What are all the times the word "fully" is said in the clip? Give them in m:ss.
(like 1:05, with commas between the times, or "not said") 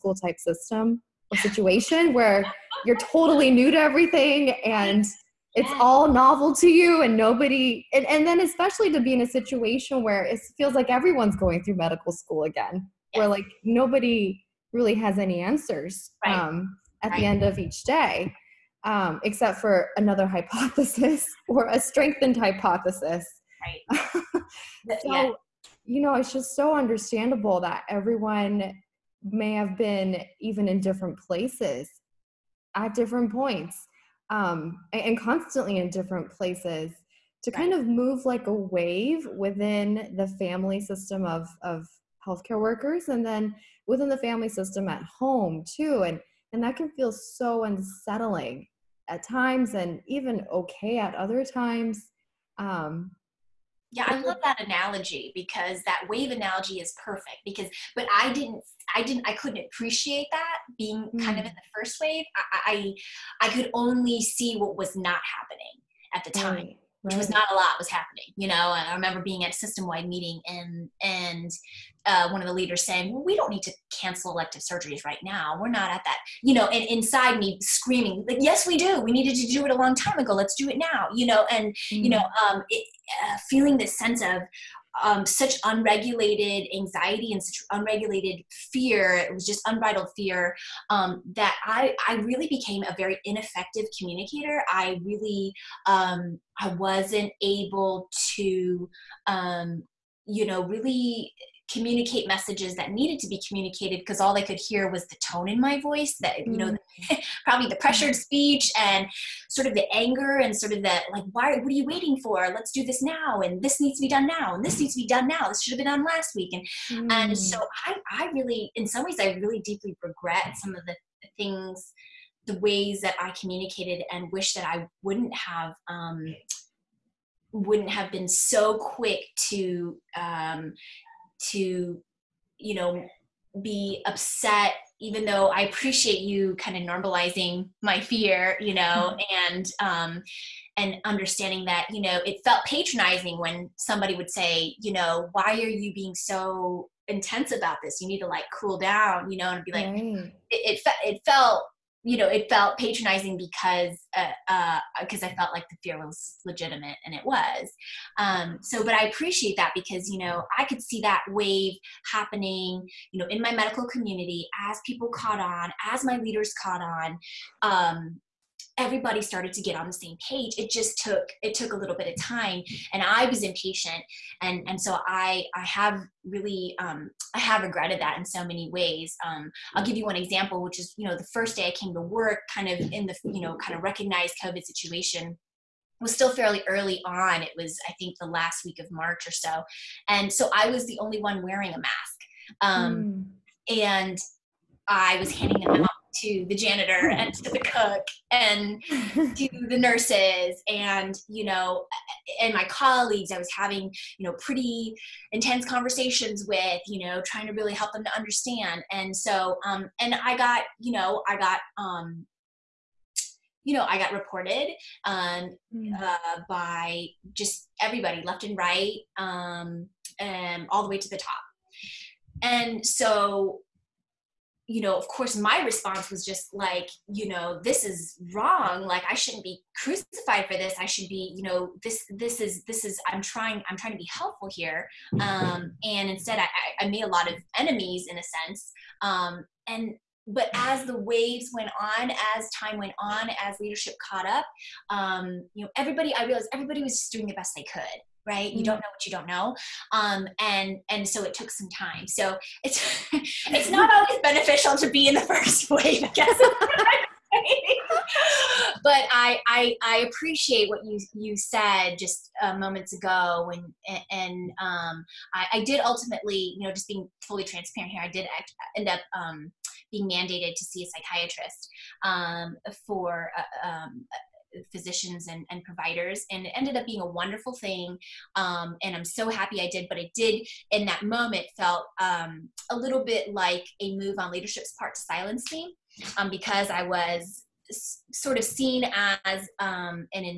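4:27.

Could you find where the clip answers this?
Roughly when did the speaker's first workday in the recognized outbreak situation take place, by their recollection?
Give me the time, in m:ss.
3:08.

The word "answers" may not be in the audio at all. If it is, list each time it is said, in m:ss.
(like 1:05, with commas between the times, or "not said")
0:15.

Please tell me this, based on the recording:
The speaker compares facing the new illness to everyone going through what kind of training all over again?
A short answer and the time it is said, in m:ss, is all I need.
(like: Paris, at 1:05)
medical school, at 0:11.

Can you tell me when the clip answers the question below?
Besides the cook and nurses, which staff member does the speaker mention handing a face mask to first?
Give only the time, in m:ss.
3:16.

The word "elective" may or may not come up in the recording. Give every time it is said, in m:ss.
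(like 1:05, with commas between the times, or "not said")
1:14.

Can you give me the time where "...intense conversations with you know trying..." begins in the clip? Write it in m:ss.
3:25.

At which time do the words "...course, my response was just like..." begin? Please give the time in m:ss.
3:45.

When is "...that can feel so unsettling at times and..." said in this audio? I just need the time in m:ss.
0:46.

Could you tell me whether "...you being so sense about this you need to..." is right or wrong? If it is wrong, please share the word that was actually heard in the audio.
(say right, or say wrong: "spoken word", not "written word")
wrong: "intense", not "sense".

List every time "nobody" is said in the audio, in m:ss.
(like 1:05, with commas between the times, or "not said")
0:07, 0:13.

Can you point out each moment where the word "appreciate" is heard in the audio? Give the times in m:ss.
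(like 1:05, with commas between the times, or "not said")
0:59, 2:15, 2:39, 4:20.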